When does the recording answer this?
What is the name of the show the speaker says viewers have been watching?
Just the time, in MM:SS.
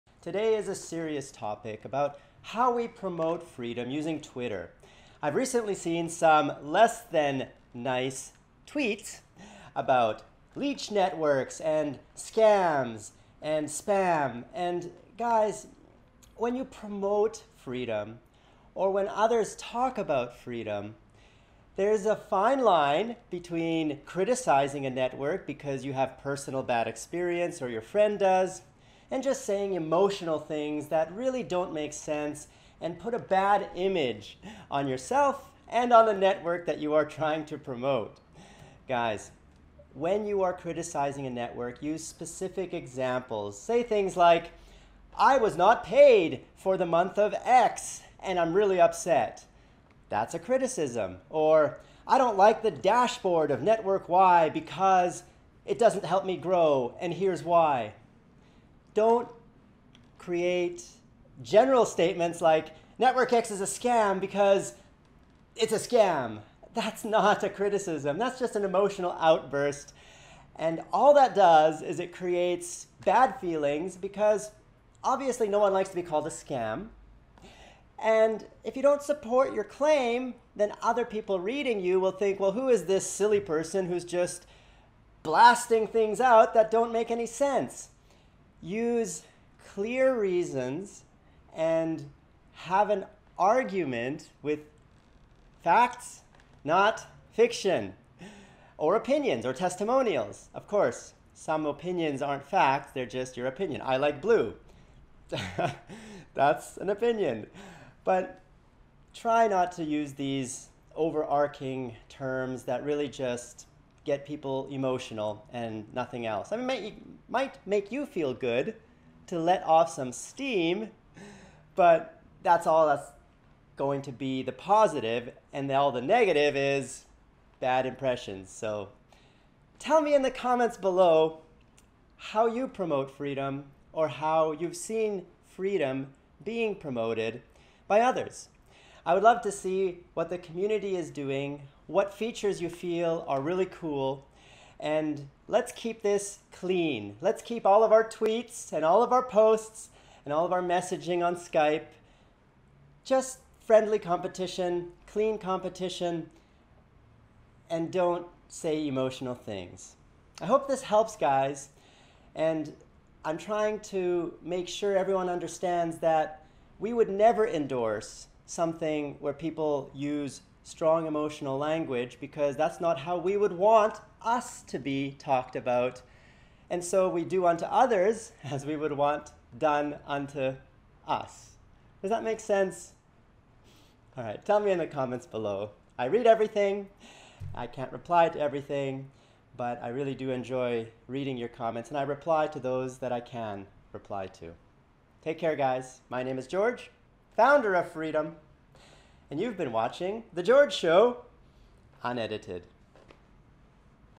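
03:20.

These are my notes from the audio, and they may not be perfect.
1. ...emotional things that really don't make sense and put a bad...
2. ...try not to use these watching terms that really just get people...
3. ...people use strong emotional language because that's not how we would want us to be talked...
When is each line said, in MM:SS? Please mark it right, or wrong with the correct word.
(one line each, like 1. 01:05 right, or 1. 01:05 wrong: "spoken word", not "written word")
1. 00:29 right
2. 01:49 wrong: "overarching", not "watching"
3. 02:49 right.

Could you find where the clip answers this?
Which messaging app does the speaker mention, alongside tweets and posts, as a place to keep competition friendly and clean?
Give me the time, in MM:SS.
02:31.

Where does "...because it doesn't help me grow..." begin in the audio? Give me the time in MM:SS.
00:54.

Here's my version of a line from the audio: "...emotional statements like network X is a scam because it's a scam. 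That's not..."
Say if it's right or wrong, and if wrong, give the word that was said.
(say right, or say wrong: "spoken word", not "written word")
wrong: "general", not "emotional".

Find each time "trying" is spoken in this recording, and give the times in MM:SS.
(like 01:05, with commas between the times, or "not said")
00:37, 02:43.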